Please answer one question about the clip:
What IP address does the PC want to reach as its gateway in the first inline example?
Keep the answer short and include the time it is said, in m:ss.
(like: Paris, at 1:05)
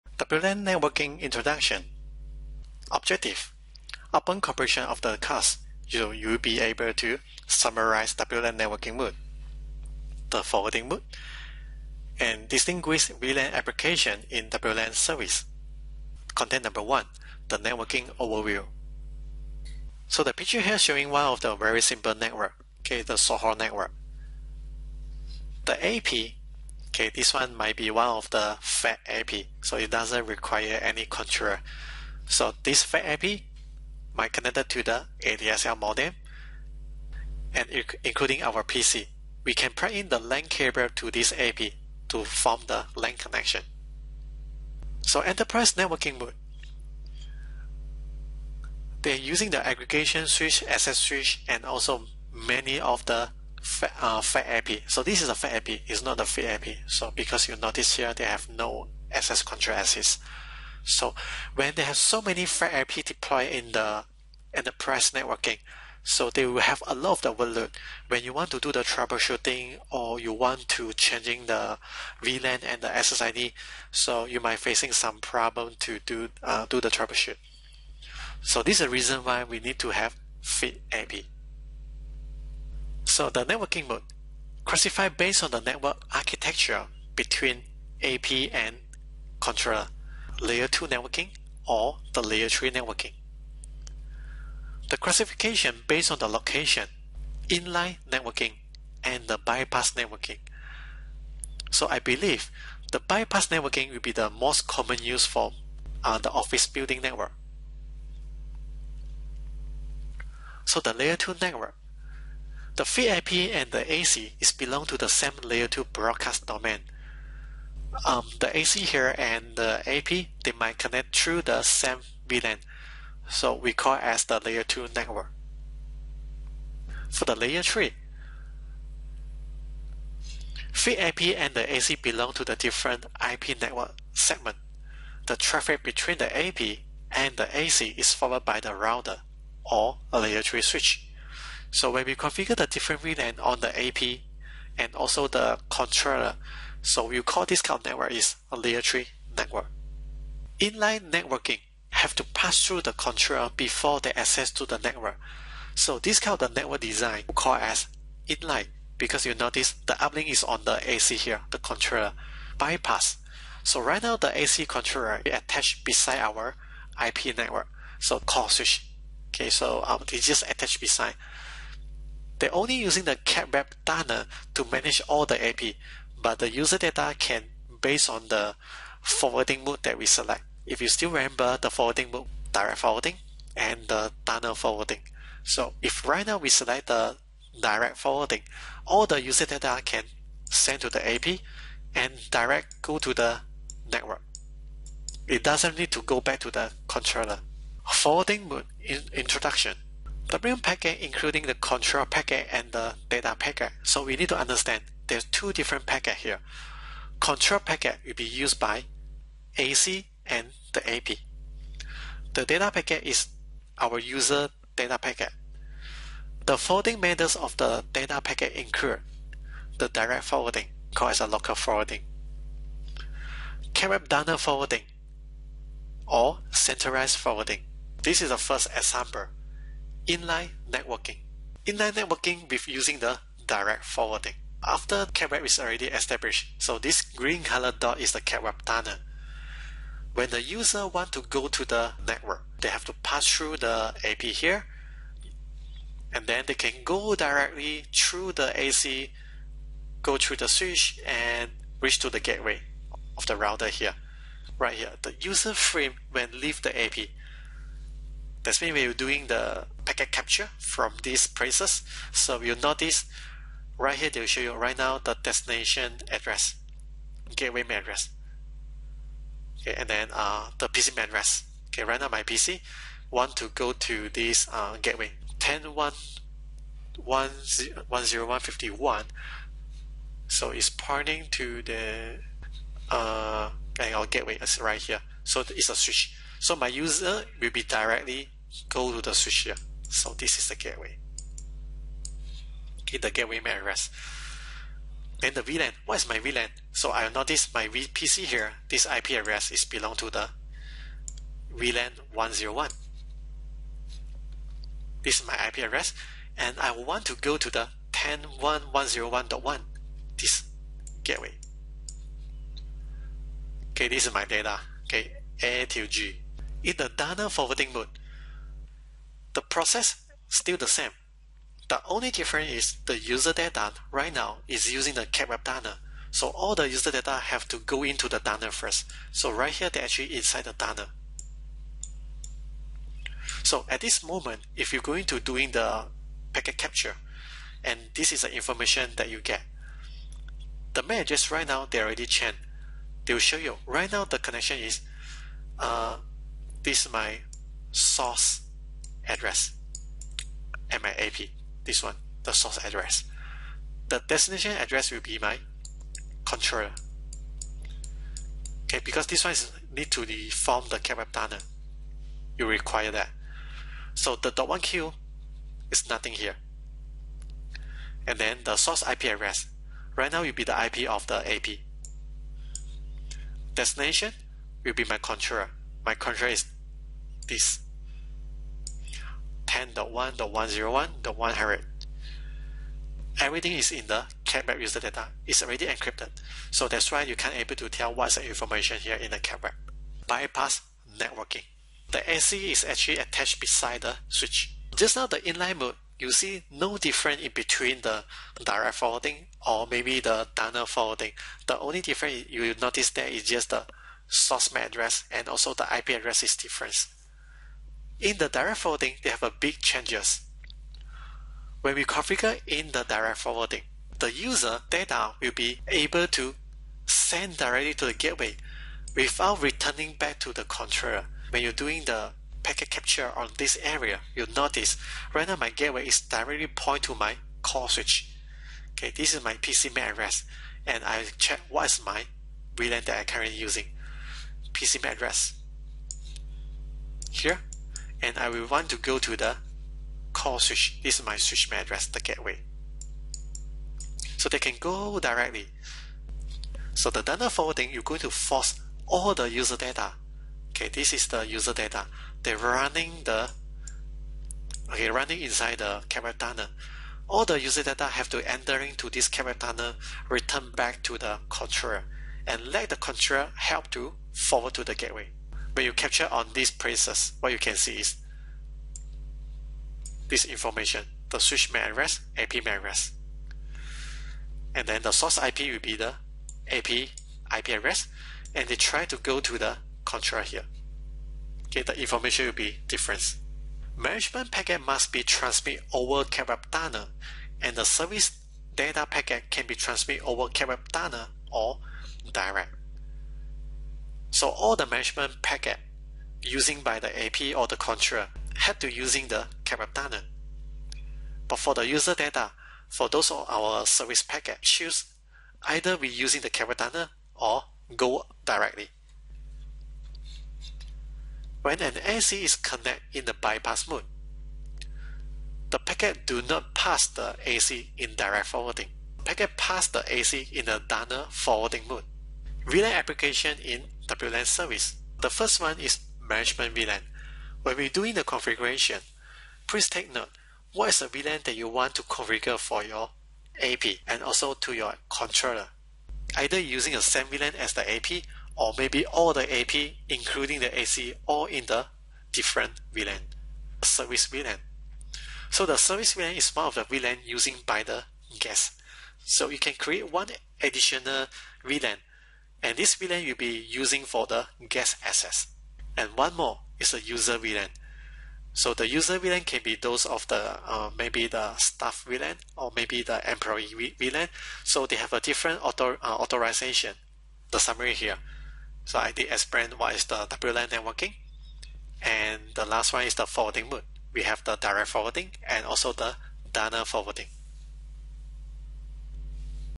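10.1.101.1, at 5:07.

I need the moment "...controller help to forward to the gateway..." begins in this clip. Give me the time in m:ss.
7:42.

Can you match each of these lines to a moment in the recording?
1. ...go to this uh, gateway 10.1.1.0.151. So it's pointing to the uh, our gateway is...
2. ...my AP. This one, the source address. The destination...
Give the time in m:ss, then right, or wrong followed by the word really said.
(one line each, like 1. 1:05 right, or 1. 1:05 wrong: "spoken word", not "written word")
1. 4:33 right
2. 5:50 right.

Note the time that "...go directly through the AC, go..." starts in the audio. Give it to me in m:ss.
4:06.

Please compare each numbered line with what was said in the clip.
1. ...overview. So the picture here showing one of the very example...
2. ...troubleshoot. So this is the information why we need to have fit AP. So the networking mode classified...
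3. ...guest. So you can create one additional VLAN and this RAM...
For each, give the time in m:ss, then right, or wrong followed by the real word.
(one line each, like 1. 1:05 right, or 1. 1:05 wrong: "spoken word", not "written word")
1. 0:18 wrong: "simple", not "example"
2. 1:16 wrong: "reason", not "information"
3. 9:08 wrong: "VLAN", not "RAM".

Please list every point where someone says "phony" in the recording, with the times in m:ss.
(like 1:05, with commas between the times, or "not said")
not said.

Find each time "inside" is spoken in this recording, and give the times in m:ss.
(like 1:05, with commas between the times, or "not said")
5:30, 7:35.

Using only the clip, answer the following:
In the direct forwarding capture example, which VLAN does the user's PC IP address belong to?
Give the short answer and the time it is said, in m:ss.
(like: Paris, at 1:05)
VLAN 101, at 5:01.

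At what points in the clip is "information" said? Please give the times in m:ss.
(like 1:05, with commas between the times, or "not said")
5:38, 6:28, 7:50, 8:01.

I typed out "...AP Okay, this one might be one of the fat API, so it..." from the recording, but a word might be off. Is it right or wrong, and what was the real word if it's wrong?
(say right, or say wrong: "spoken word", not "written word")
right.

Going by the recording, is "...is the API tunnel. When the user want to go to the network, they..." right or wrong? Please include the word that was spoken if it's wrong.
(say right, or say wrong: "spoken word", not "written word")
wrong: "CAPWAP", not "API".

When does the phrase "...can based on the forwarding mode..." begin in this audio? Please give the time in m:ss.
2:57.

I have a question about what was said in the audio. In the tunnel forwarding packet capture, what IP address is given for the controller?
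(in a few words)
10.1.101.100.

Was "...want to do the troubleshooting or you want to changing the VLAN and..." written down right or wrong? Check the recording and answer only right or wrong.
right.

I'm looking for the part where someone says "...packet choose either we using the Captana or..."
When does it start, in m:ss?
8:24.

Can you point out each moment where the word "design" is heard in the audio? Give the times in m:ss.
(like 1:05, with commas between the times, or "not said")
2:36.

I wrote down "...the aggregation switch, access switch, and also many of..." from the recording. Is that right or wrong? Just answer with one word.
right.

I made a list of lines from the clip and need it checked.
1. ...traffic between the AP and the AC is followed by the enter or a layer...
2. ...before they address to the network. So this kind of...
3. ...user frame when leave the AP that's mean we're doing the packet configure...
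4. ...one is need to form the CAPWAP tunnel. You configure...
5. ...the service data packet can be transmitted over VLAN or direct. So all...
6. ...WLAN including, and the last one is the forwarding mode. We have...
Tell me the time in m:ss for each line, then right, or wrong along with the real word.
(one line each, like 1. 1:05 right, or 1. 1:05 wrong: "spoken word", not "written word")
1. 2:15 wrong: "router", not "enter"
2. 2:33 wrong: "access", not "address"
3. 4:15 wrong: "capture", not "configure"
4. 5:59 wrong: "require", not "configure"
5. 8:07 wrong: "CAPWAP", not "VLAN"
6. 9:30 wrong: "networking", not "including".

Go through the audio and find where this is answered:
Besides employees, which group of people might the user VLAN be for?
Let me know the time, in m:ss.
9:21.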